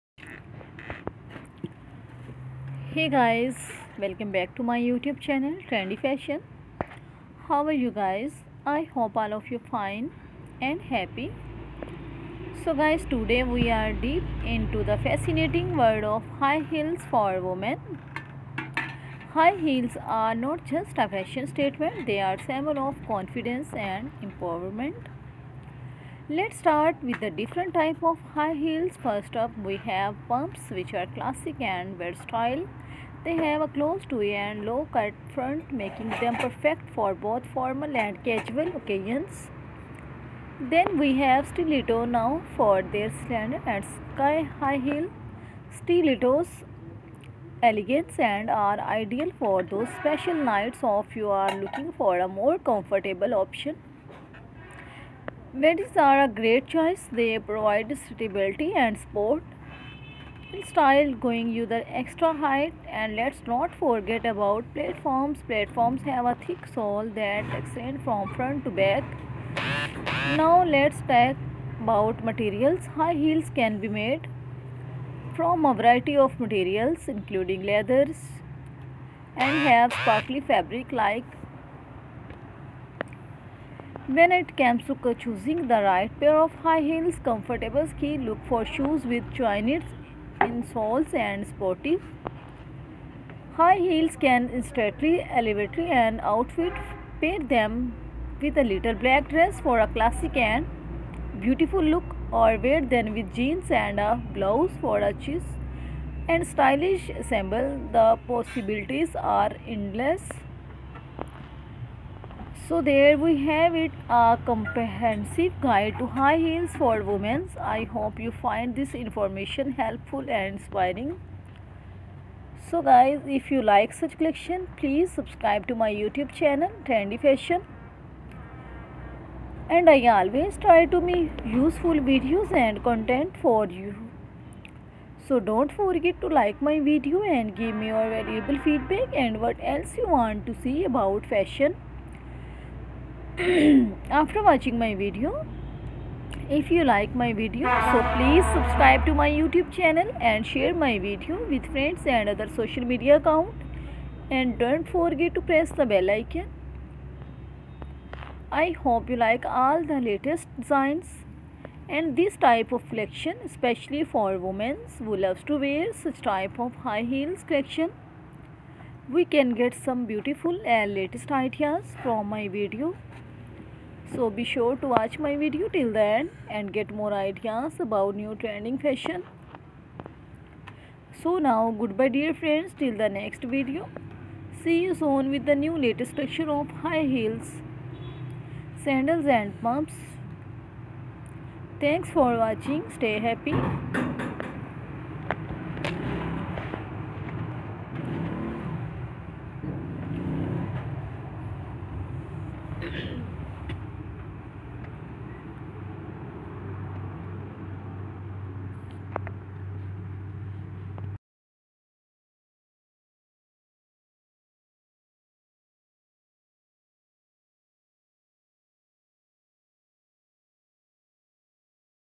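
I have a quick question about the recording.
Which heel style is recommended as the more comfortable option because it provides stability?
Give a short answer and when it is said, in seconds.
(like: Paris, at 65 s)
Wedges, at 55 s.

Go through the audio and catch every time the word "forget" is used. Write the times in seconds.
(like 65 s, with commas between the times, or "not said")
63 s, 135 s, 154 s.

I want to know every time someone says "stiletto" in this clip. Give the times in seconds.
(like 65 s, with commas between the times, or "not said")
41 s, 45 s.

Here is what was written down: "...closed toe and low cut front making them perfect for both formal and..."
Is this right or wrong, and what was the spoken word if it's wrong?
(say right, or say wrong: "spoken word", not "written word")
right.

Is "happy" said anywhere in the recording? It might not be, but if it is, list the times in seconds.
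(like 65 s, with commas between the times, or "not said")
10 s, 193 s.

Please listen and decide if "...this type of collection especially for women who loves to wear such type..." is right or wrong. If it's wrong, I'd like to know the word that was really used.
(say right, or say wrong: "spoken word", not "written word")
right.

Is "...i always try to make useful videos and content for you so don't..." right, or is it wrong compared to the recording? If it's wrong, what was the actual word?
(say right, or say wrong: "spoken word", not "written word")
right.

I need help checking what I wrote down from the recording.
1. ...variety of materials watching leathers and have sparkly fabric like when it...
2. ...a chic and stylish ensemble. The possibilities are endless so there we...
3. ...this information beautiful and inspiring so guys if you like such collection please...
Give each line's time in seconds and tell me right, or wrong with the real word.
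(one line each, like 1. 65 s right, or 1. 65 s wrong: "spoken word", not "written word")
1. 75 s wrong: "including", not "watching"
2. 104 s right
3. 118 s wrong: "helpful", not "beautiful".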